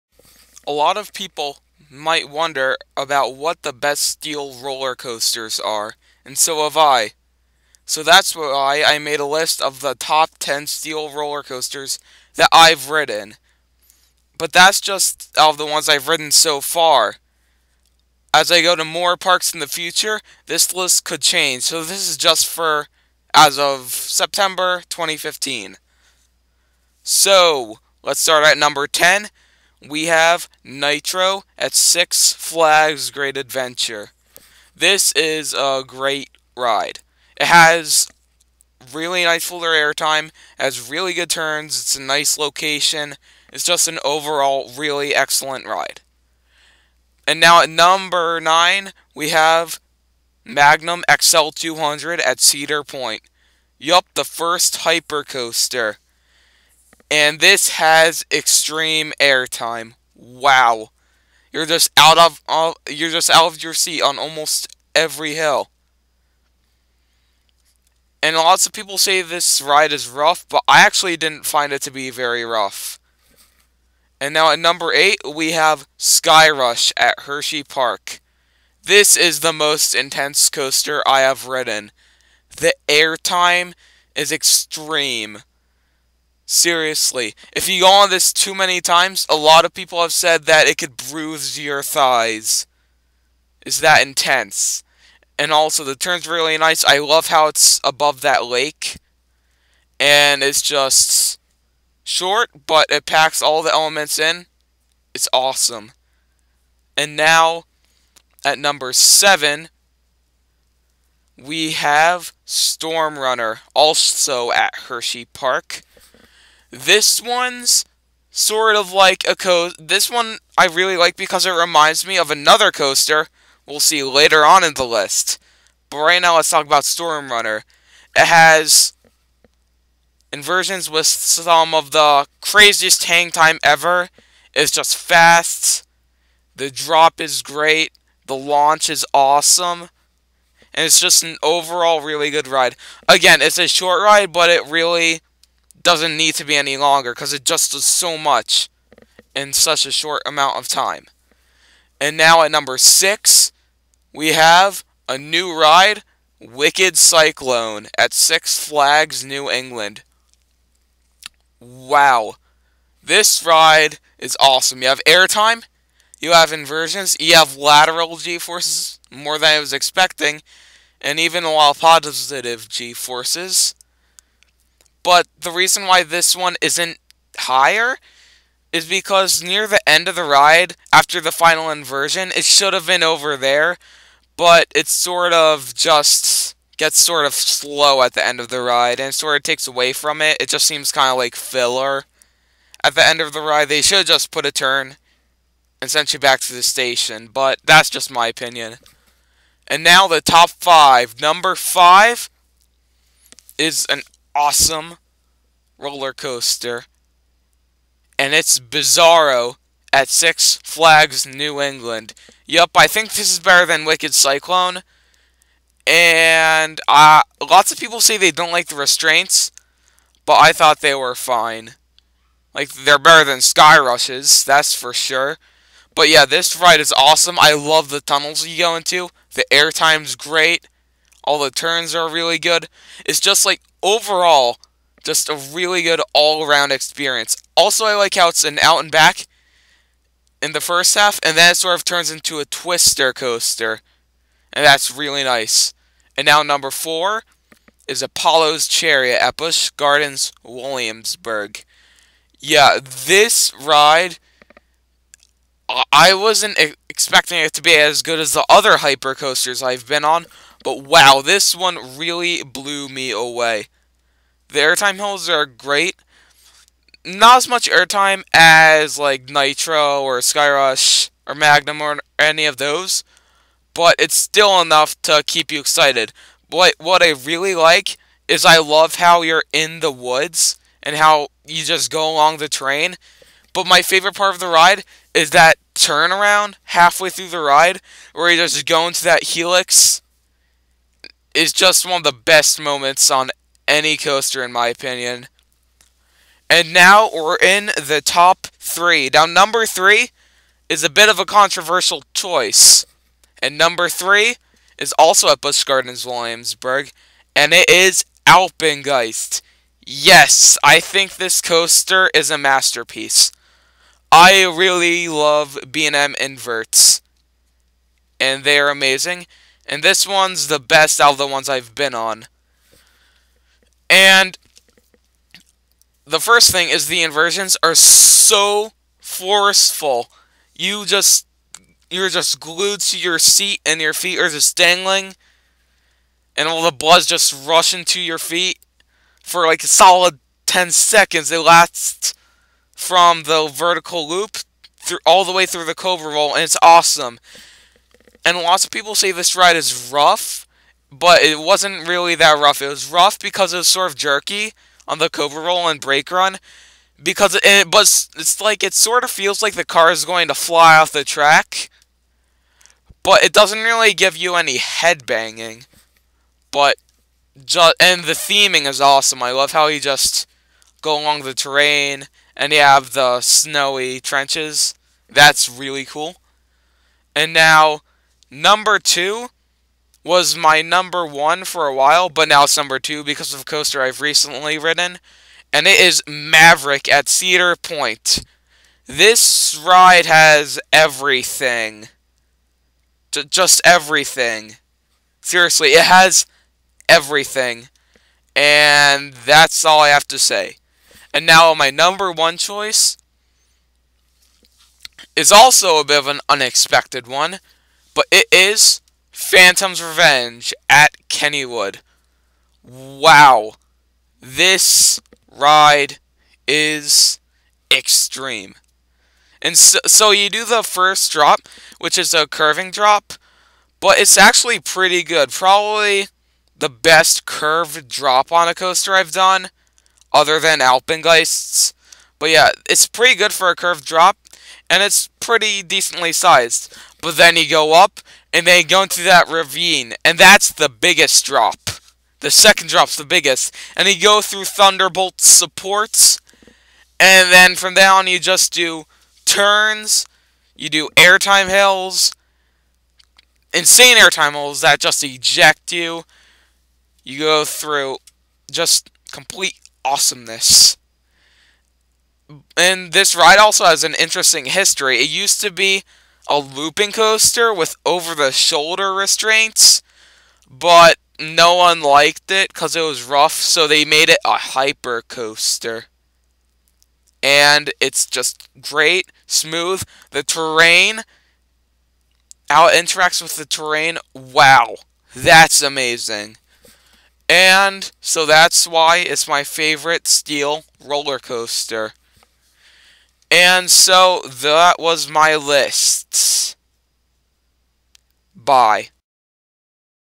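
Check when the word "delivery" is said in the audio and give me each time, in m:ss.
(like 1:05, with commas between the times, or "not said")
not said.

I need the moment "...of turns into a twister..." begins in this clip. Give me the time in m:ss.
4:01.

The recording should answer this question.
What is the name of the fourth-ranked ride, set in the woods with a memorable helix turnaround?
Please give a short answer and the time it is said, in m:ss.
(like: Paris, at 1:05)
Apollo's Chariot, at 4:08.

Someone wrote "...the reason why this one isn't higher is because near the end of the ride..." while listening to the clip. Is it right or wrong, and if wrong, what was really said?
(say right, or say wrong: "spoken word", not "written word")
right.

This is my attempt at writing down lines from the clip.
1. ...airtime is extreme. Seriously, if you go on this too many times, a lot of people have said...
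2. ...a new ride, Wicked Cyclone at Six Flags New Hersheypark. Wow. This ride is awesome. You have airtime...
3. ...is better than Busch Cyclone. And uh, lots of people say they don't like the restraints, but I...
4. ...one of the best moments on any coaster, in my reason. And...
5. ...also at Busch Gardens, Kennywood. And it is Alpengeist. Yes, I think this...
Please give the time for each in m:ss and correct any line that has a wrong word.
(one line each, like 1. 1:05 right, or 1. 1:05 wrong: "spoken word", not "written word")
1. 1:22 right
2. 2:35 wrong: "England", not "Hersheypark"
3. 3:33 wrong: "Wicked", not "Busch"
4. 4:51 wrong: "opinion", not "reason"
5. 5:04 wrong: "Williamsburg", not "Kennywood".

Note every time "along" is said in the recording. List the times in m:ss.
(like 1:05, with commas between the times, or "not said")
4:42, 6:11.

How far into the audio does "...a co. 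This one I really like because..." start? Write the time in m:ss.
1:59.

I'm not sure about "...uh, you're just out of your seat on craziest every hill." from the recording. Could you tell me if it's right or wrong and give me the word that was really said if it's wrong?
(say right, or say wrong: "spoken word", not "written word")
wrong: "almost", not "craziest".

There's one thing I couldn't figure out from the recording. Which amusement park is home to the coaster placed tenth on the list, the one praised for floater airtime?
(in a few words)
Six Flags Great Adventure.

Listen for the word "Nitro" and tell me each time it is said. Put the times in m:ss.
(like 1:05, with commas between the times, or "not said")
0:30, 4:29.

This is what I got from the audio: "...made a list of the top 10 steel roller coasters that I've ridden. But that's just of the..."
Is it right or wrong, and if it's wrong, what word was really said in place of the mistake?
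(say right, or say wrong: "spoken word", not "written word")
right.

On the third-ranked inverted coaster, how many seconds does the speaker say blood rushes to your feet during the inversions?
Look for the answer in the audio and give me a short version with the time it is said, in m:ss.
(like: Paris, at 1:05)
10, at 5:40.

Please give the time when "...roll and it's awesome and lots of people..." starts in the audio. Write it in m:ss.
5:46.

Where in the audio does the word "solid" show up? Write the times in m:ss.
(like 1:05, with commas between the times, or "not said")
5:39.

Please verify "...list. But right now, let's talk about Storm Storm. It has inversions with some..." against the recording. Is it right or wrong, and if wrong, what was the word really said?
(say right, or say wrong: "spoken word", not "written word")
wrong: "Runner", not "Storm".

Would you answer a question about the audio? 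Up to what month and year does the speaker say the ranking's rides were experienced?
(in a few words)
September 2015.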